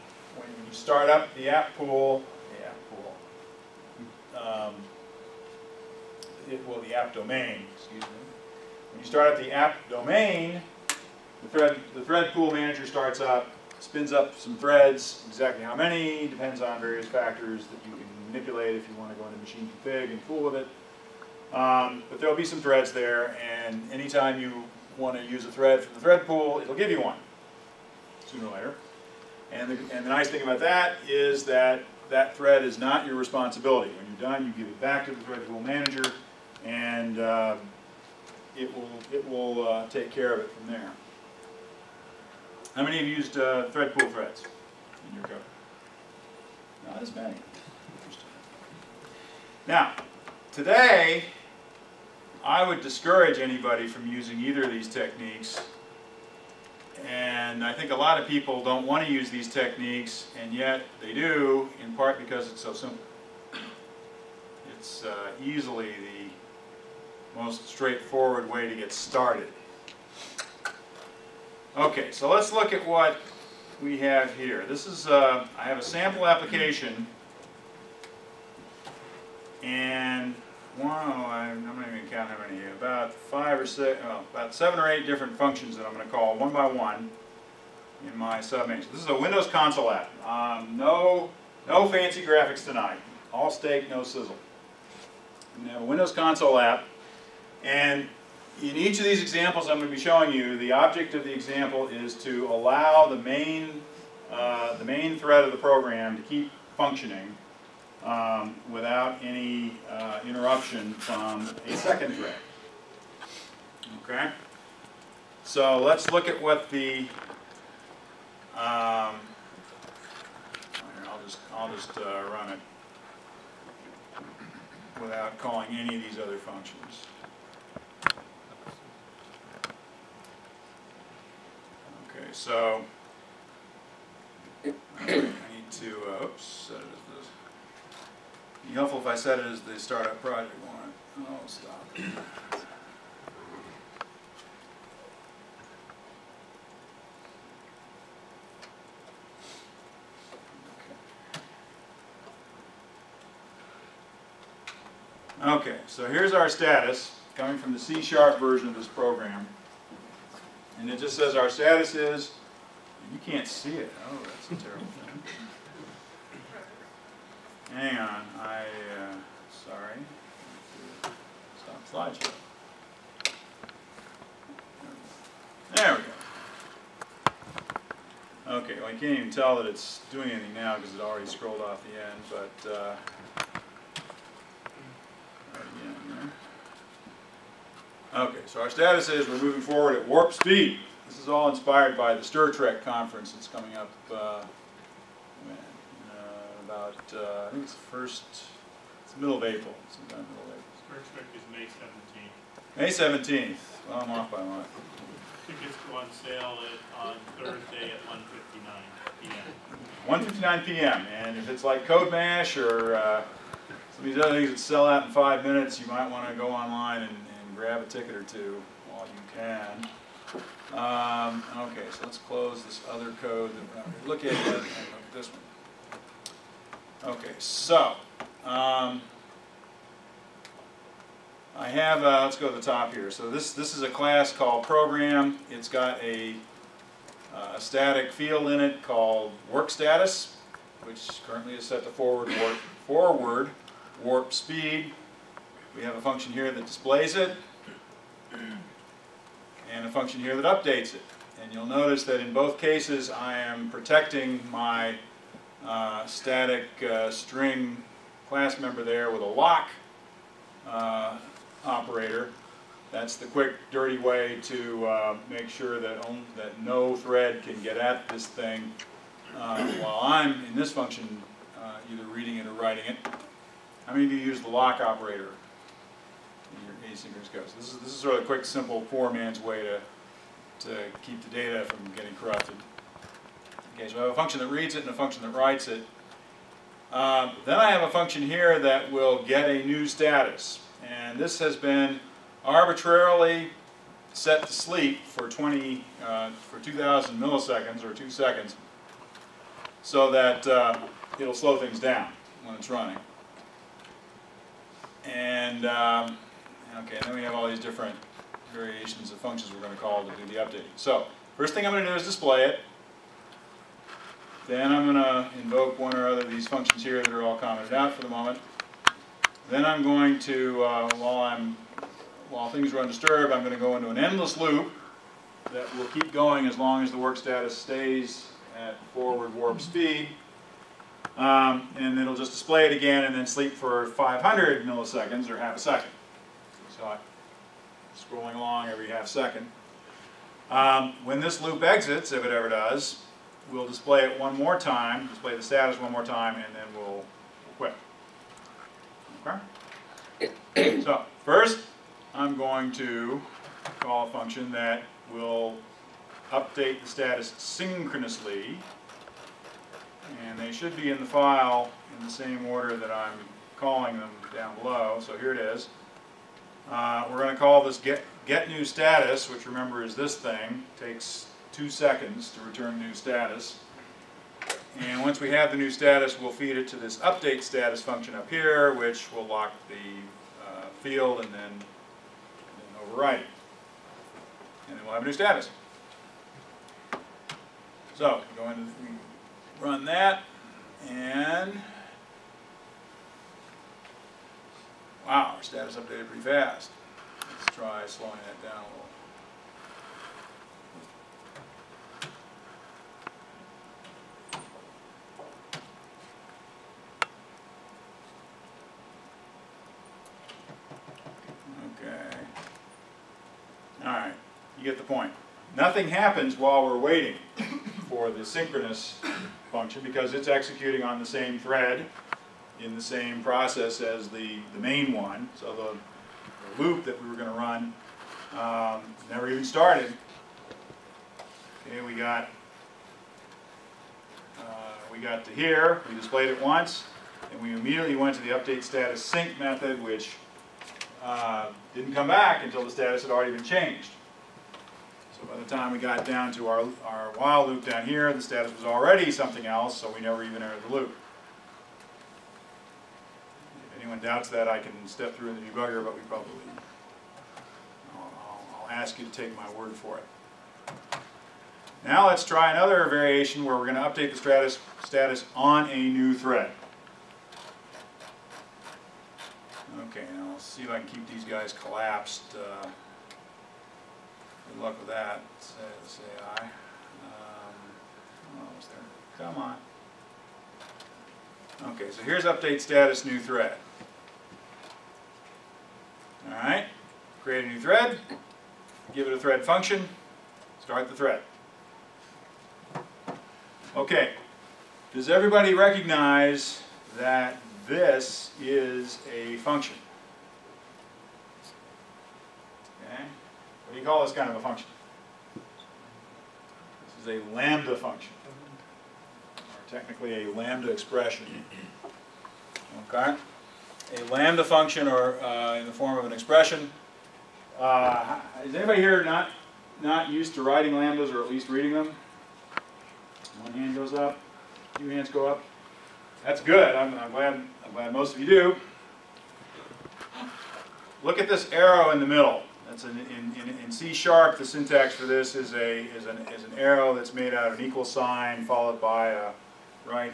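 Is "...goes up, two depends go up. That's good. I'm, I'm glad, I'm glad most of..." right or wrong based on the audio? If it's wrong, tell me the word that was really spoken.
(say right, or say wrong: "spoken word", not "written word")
wrong: "hands", not "depends".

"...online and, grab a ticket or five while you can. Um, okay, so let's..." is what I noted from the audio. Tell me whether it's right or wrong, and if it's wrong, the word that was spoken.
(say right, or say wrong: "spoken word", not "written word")
wrong: "two", not "five".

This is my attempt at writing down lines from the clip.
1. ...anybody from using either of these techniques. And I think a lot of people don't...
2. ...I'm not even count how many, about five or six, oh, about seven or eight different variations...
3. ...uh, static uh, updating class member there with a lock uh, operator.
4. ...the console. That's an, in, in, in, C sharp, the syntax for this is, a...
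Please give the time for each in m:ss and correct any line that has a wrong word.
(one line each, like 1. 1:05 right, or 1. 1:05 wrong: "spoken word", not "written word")
1. 0:53 right
2. 1:21 wrong: "functions", not "variations"
3. 4:15 wrong: "string", not "updating"
4. 8:52 wrong: "middle", not "console".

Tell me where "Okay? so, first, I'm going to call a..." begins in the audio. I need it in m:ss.
5:49.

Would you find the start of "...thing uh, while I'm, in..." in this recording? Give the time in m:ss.
4:28.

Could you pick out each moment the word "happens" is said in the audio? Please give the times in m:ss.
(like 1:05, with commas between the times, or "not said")
6:55.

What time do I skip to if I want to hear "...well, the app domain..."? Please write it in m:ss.
0:06.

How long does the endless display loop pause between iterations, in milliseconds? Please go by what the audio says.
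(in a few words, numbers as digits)
500.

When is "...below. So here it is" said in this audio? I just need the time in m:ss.
6:04.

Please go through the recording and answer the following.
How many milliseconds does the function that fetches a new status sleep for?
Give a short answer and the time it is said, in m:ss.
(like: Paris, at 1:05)
2000, at 4:56.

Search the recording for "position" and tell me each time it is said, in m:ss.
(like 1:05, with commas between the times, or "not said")
not said.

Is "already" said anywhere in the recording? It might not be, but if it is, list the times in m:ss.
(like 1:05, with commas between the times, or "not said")
3:01, 7:23, 7:28.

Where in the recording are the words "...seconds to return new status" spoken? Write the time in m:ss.
6:11.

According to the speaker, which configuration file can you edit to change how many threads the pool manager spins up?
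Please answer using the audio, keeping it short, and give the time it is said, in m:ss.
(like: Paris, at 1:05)
machine config, at 0:19.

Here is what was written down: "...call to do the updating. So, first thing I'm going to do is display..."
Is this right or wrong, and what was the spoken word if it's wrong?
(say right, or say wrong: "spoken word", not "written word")
right.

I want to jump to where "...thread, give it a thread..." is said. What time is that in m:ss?
8:07.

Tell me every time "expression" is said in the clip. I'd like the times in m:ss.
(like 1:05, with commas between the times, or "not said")
8:30, 8:36.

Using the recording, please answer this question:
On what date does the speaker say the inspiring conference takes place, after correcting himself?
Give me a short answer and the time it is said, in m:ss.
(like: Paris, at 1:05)
May 17th, at 3:22.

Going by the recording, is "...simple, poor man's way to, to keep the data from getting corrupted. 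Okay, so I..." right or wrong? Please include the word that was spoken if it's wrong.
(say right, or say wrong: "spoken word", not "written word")
right.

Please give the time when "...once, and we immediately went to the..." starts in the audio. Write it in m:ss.
7:16.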